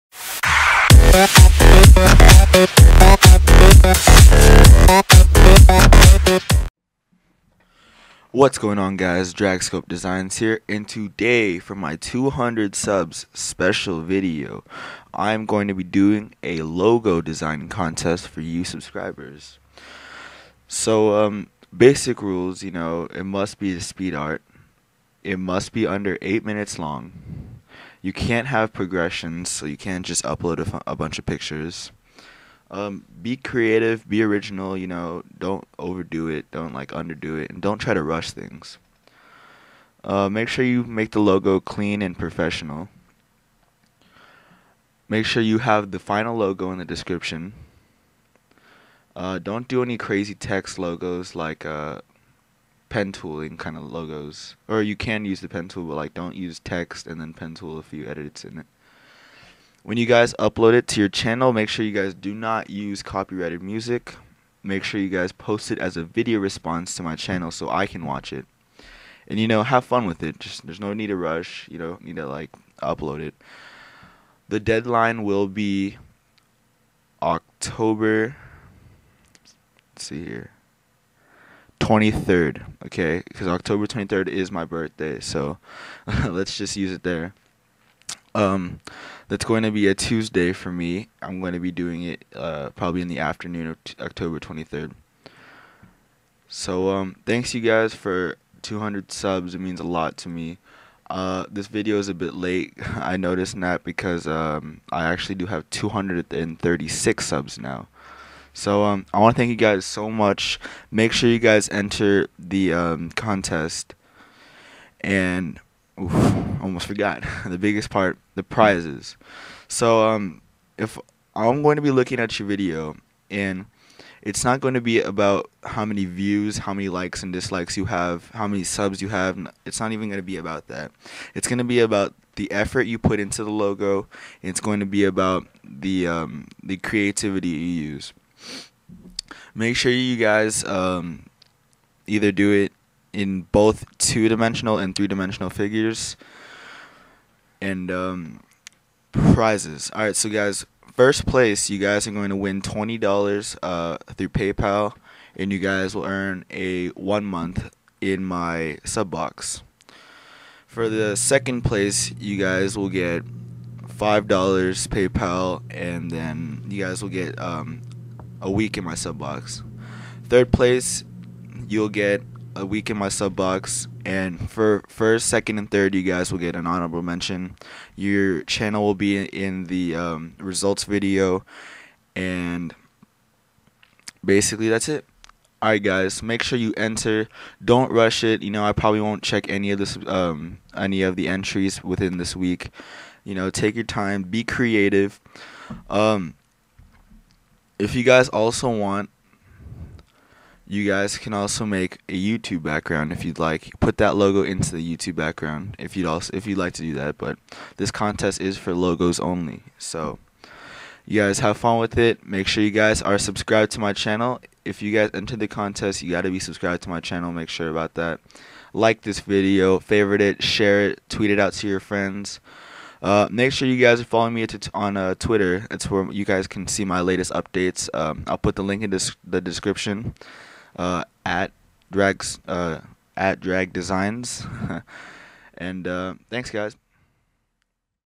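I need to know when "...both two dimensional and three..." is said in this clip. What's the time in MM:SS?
02:23.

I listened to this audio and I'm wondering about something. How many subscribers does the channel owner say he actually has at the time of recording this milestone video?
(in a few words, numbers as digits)
236.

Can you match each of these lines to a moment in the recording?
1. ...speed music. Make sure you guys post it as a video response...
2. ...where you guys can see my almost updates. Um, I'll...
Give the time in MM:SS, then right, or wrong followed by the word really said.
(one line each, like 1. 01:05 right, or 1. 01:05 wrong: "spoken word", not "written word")
1. 01:03 wrong: "copyrighted", not "speed"
2. 03:45 wrong: "latest", not "almost".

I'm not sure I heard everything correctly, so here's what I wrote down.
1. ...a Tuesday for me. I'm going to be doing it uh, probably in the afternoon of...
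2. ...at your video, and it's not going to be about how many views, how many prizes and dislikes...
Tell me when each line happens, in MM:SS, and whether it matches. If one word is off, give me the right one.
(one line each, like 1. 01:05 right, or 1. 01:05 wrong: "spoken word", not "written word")
1. 01:29 right
2. 02:02 wrong: "likes", not "prizes".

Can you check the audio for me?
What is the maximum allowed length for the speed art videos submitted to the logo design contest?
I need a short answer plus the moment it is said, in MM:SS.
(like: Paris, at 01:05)
8 minutes, at 00:26.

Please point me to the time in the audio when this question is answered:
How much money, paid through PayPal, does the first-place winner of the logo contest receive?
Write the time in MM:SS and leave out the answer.
02:32.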